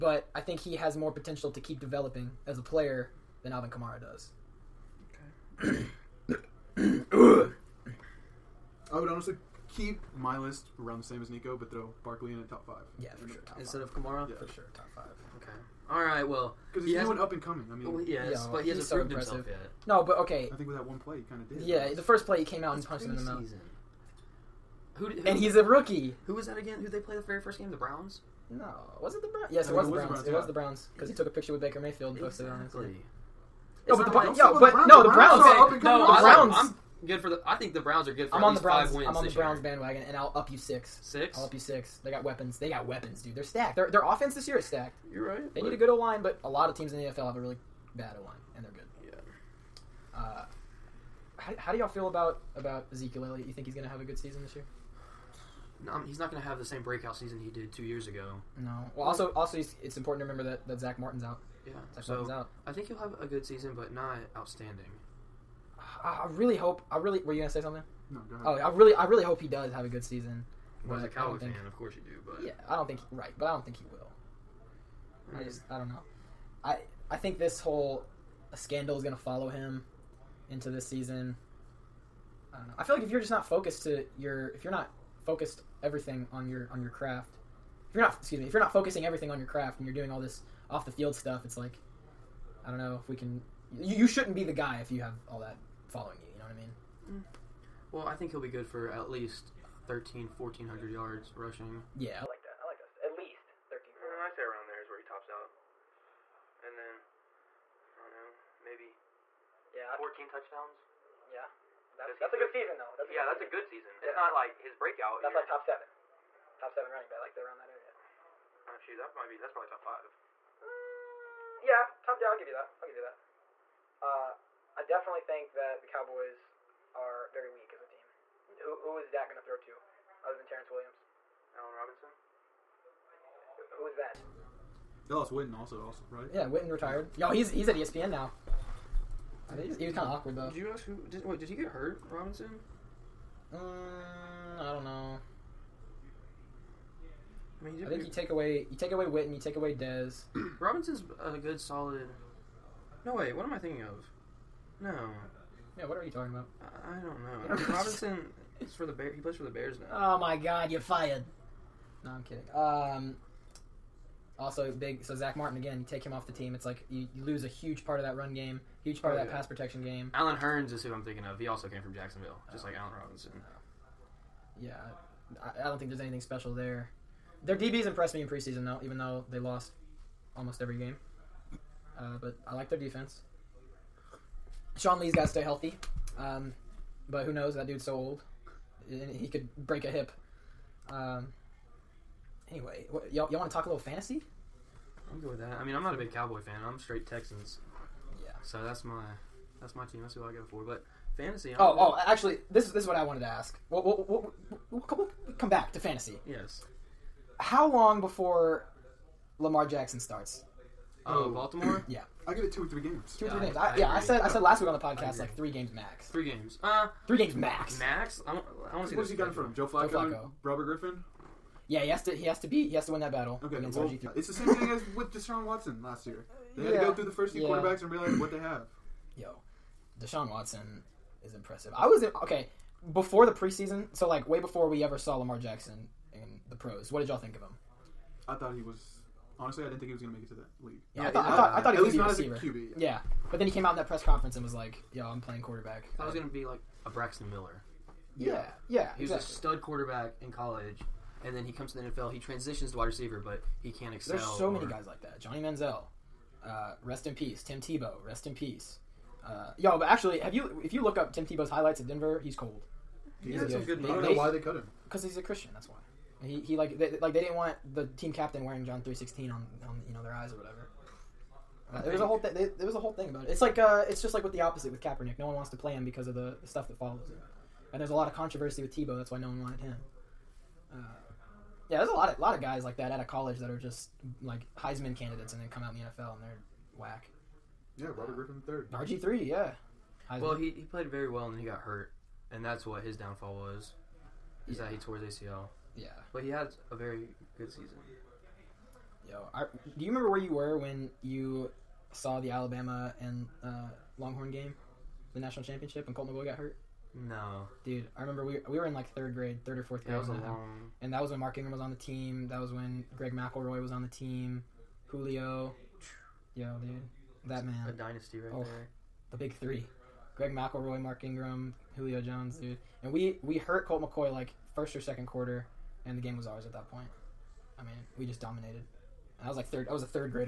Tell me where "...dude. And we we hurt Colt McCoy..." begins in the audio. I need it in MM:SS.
05:22.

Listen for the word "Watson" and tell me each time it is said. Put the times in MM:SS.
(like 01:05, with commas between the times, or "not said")
03:45, 03:50.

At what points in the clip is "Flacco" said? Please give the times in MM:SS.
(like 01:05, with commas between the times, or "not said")
03:39.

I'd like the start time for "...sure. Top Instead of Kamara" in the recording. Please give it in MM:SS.
00:13.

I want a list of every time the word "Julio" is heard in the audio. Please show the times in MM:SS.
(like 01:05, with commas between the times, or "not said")
05:14, 05:21.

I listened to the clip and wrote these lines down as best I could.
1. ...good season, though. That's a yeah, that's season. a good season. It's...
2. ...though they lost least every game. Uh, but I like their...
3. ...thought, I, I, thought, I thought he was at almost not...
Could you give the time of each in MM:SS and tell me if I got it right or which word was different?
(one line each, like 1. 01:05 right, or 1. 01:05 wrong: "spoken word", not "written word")
1. 01:52 right
2. 02:58 wrong: "almost", not "least"
3. 04:01 wrong: "least", not "almost".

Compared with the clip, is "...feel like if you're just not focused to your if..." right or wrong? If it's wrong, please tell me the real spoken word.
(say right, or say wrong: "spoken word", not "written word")
right.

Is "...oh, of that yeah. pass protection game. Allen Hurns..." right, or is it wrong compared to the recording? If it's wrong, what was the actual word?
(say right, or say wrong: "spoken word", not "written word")
right.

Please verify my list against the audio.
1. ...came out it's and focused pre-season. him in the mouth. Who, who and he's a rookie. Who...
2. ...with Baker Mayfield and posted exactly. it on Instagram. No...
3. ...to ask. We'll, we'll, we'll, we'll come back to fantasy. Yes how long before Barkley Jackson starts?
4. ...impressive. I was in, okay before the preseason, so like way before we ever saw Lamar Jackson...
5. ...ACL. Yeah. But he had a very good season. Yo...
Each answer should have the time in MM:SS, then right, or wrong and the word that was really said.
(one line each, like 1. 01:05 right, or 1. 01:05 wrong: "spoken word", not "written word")
1. 00:22 wrong: "punched", not "focused"
2. 00:31 right
3. 03:23 wrong: "Lamar", not "Barkley"
4. 03:51 right
5. 04:55 right.